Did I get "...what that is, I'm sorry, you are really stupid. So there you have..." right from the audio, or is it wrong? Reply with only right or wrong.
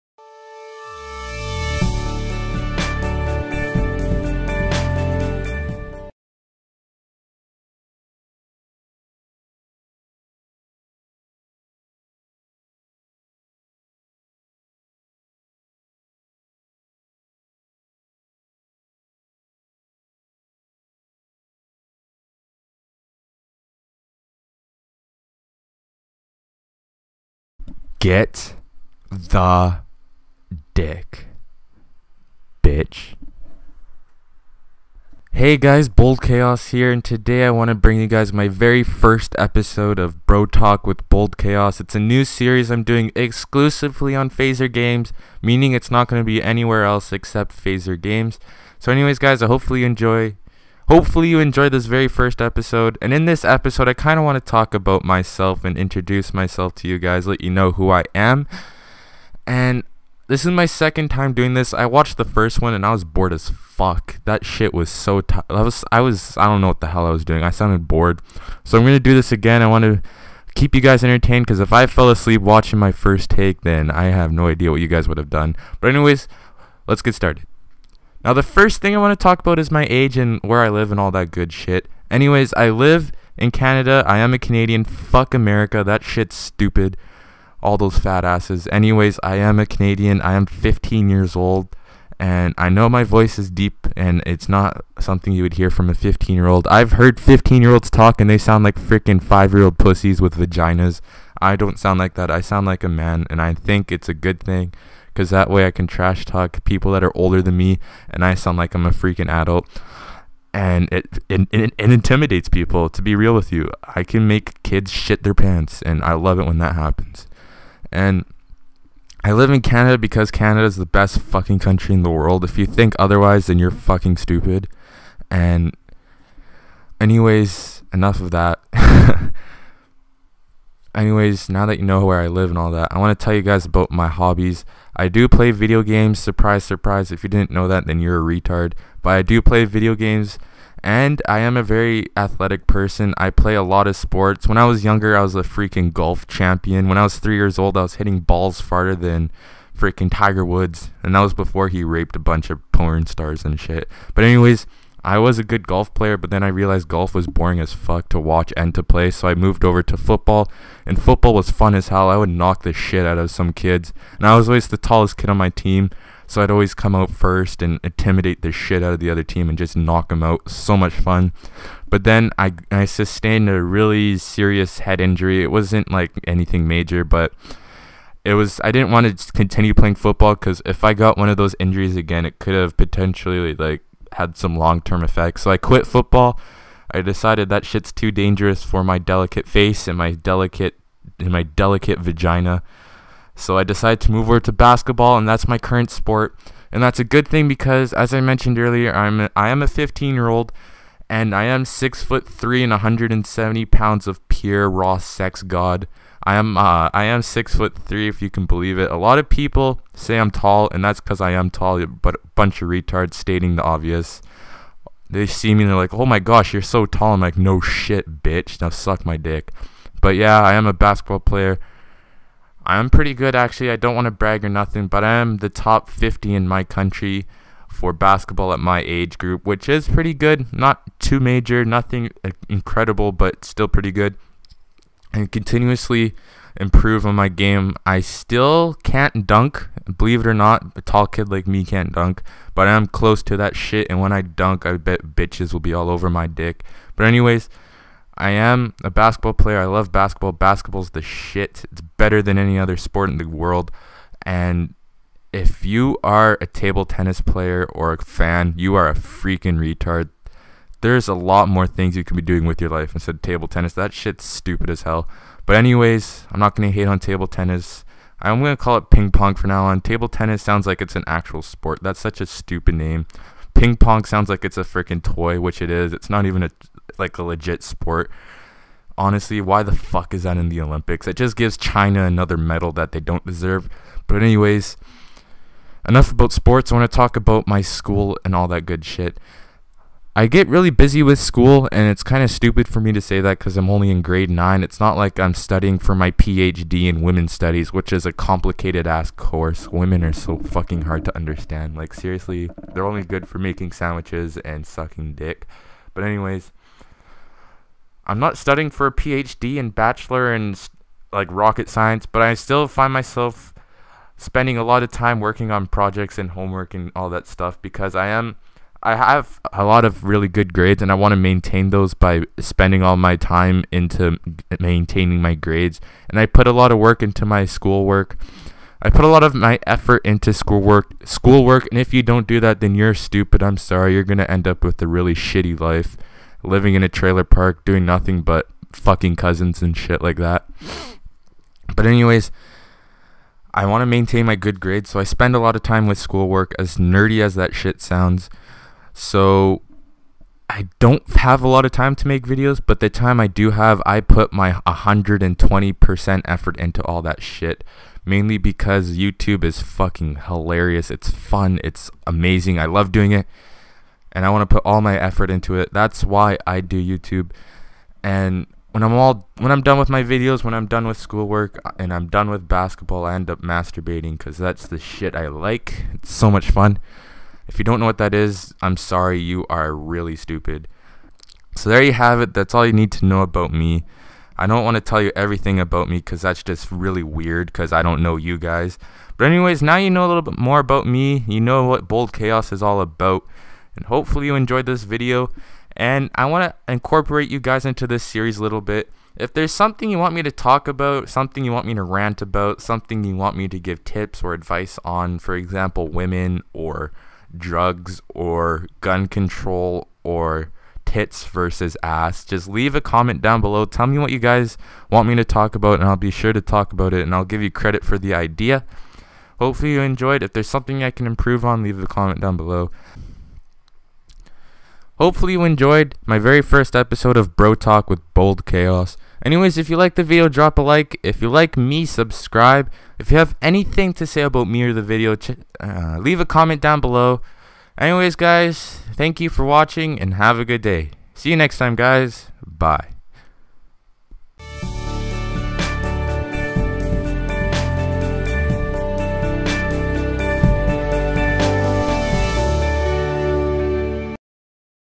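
right.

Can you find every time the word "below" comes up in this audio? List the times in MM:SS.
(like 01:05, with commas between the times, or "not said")
06:53, 07:02, 07:16.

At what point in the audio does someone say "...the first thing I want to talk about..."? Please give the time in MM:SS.
01:18.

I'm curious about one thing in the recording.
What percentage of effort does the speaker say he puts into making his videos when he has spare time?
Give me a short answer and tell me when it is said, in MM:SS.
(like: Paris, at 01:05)
120%, at 05:54.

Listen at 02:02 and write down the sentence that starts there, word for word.
If you think otherwise, then you're fucking stupid.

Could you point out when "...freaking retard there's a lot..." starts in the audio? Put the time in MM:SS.
04:18.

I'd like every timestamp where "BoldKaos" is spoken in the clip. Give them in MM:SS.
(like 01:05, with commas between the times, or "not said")
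00:35, 00:41, 06:31, 07:08.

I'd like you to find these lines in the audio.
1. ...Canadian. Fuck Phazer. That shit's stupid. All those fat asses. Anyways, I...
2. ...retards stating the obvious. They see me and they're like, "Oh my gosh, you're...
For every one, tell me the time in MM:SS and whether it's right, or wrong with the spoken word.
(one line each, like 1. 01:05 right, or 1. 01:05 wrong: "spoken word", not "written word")
1. 01:24 wrong: "America", not "Phazer"
2. 03:32 right.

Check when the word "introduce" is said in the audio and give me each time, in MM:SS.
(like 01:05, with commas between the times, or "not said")
00:55.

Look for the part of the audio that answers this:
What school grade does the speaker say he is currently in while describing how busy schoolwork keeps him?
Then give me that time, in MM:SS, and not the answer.
04:54.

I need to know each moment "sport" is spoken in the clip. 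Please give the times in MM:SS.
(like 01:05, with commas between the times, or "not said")
02:23, 03:15, 04:12, 04:31, 04:37, 04:46.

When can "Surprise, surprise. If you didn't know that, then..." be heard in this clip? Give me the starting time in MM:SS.
02:16.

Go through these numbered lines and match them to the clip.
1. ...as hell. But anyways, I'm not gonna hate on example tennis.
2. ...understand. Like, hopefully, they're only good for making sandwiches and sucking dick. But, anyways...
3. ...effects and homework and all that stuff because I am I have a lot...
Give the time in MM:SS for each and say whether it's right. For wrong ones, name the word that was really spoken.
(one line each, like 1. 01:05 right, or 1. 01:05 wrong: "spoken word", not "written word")
1. 04:24 wrong: "table", not "example"
2. 05:01 wrong: "seriously", not "hopefully"
3. 05:15 wrong: "projects", not "effects".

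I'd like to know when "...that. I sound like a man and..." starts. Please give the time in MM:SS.
01:42.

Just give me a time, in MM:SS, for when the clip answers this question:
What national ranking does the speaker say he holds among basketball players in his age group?
03:45.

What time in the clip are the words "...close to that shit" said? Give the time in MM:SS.
04:02.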